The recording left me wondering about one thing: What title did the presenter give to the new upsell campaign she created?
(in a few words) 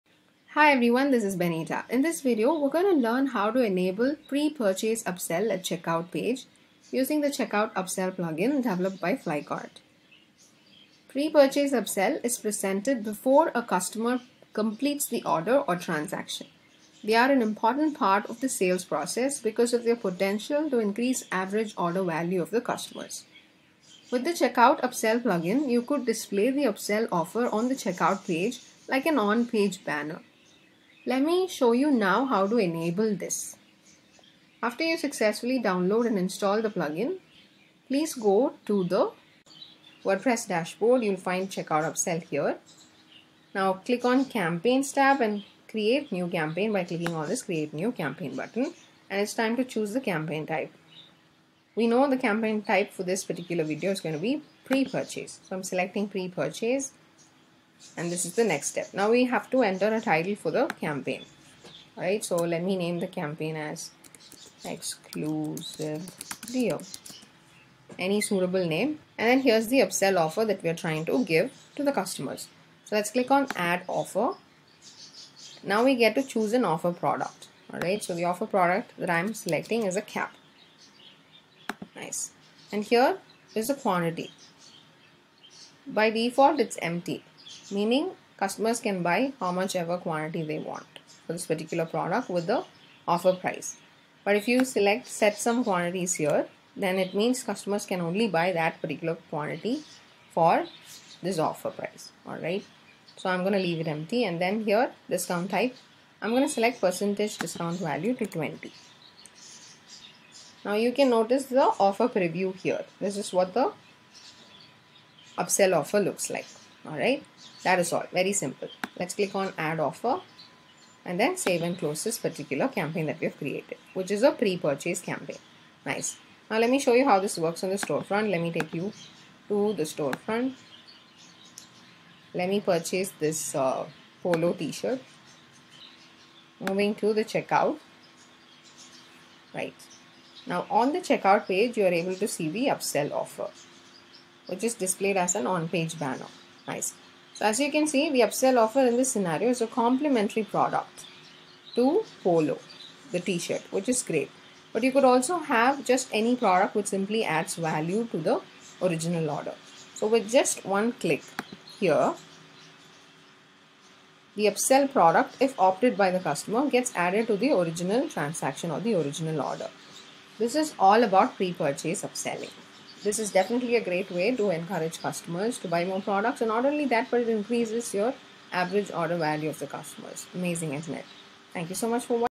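Exclusive deal.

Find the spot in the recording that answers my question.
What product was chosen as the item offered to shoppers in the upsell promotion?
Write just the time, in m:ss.
1:19.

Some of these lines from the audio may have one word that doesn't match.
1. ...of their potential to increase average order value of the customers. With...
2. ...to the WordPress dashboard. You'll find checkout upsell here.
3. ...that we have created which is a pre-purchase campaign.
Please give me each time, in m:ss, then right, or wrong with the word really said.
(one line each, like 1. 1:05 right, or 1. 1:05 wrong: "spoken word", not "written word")
1. 0:19 right
2. 0:38 right
3. 2:03 right.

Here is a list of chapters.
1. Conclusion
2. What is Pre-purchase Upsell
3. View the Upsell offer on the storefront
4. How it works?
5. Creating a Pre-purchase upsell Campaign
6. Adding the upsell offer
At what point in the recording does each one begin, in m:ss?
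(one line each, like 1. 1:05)
1. 2:50
2. 0:10
3. 2:20
4. 2:06
5. 0:24
6. 1:09.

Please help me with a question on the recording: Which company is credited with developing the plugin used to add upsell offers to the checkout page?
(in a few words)
Flycart.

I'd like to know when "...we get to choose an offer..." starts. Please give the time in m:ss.
1:15.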